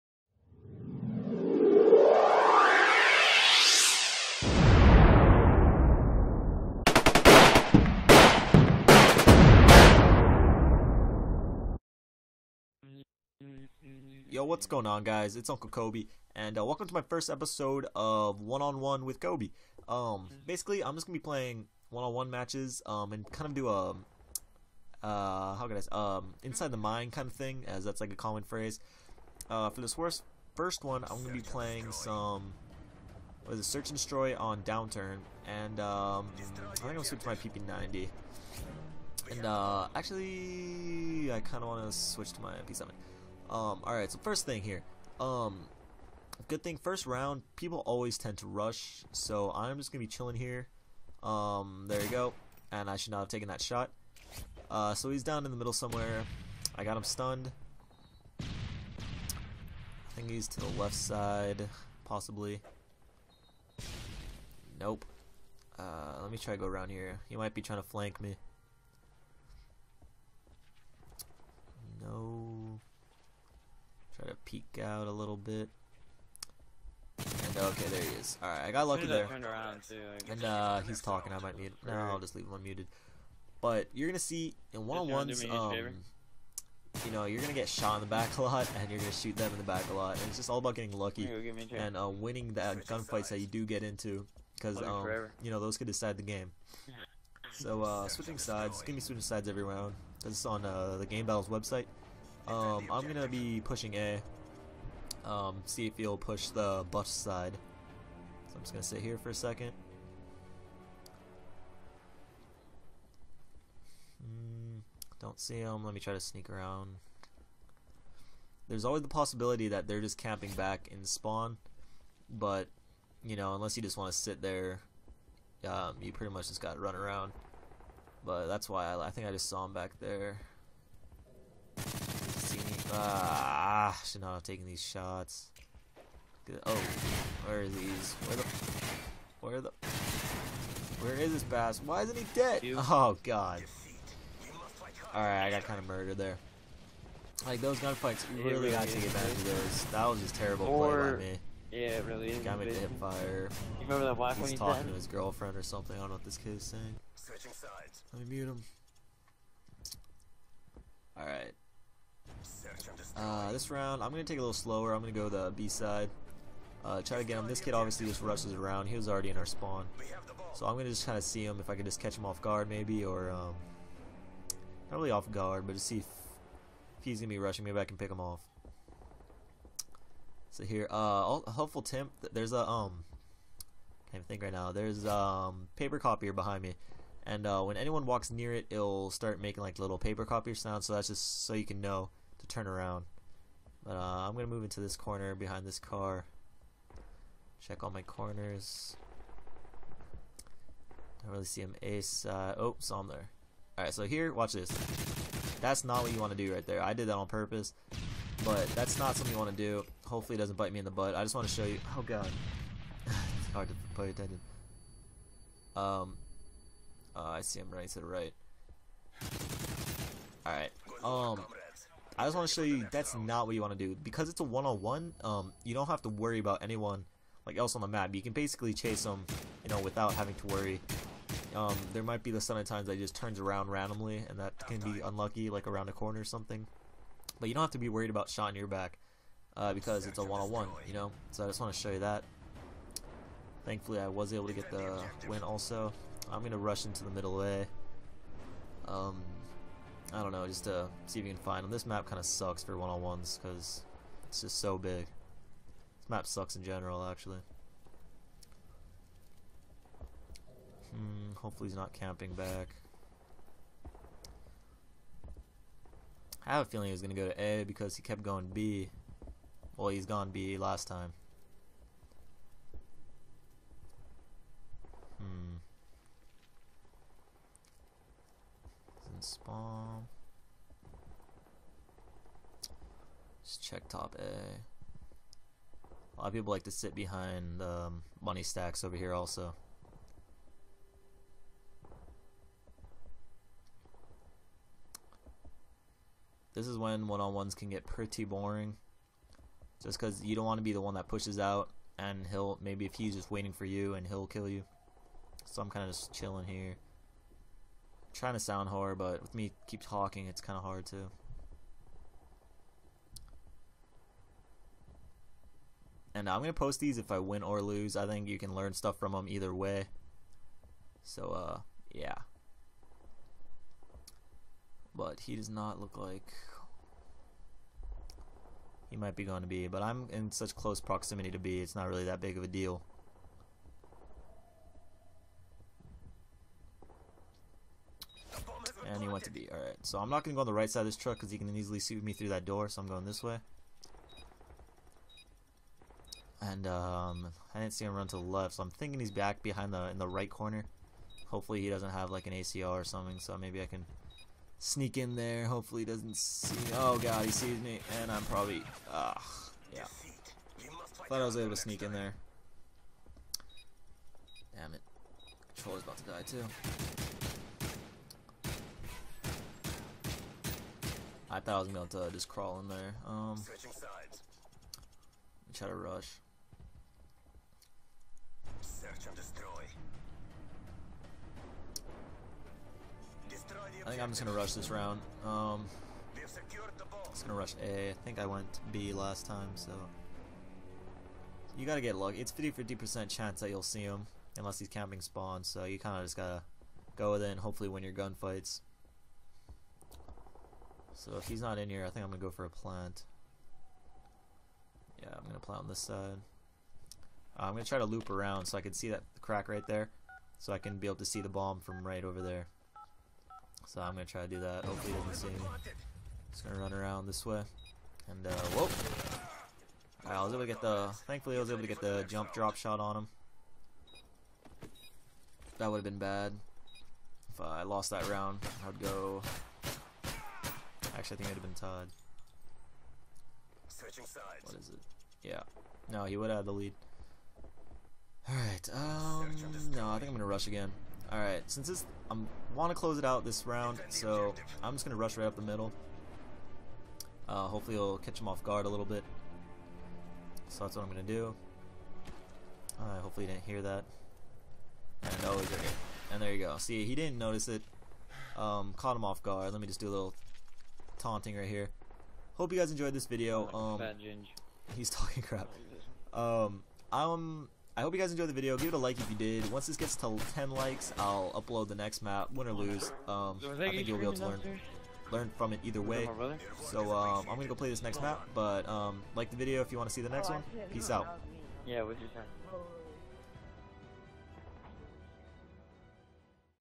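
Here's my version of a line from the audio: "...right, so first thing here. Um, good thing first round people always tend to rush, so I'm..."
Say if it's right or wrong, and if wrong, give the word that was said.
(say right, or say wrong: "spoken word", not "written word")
right.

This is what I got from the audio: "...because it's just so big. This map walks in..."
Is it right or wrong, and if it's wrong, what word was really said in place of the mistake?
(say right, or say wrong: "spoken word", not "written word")
wrong: "sucks", not "walks".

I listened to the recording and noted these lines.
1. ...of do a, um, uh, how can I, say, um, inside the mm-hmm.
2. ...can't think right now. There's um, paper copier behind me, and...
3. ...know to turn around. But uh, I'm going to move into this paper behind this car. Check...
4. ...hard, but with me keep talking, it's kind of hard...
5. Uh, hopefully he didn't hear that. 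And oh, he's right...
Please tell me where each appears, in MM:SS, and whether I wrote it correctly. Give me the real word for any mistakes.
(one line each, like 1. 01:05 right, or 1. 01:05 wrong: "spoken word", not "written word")
1. 00:23 right
2. 03:04 right
3. 03:11 wrong: "corner", not "paper"
4. 05:08 right
5. 07:32 right.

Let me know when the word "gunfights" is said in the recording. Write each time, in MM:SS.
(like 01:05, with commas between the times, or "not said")
01:32, 02:27, 06:37.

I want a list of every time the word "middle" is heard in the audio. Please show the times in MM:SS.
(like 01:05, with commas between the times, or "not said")
00:55, 04:07, 07:25.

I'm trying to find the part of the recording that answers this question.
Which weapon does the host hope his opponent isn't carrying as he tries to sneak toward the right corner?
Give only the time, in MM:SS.
05:52.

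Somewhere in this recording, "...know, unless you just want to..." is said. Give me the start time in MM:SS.
02:03.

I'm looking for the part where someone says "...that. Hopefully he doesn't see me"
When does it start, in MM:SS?
06:54.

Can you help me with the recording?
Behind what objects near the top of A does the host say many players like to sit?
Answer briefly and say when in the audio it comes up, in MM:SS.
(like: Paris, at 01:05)
money stacks, at 04:48.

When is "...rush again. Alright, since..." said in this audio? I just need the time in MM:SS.
07:20.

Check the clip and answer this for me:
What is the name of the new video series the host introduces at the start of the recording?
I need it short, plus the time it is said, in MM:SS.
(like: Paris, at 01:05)
One on One with Kobe, at 00:18.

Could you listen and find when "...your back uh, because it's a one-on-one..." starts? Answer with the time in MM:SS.
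03:58.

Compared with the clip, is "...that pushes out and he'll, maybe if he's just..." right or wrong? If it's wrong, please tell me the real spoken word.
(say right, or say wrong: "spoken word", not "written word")
right.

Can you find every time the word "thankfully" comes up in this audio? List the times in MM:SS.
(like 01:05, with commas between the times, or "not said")
04:03, 07:01.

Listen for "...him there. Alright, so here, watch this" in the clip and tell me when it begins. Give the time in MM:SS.
03:23.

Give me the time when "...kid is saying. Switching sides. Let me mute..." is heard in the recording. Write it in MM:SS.
02:36.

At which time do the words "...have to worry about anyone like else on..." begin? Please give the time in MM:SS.
03:45.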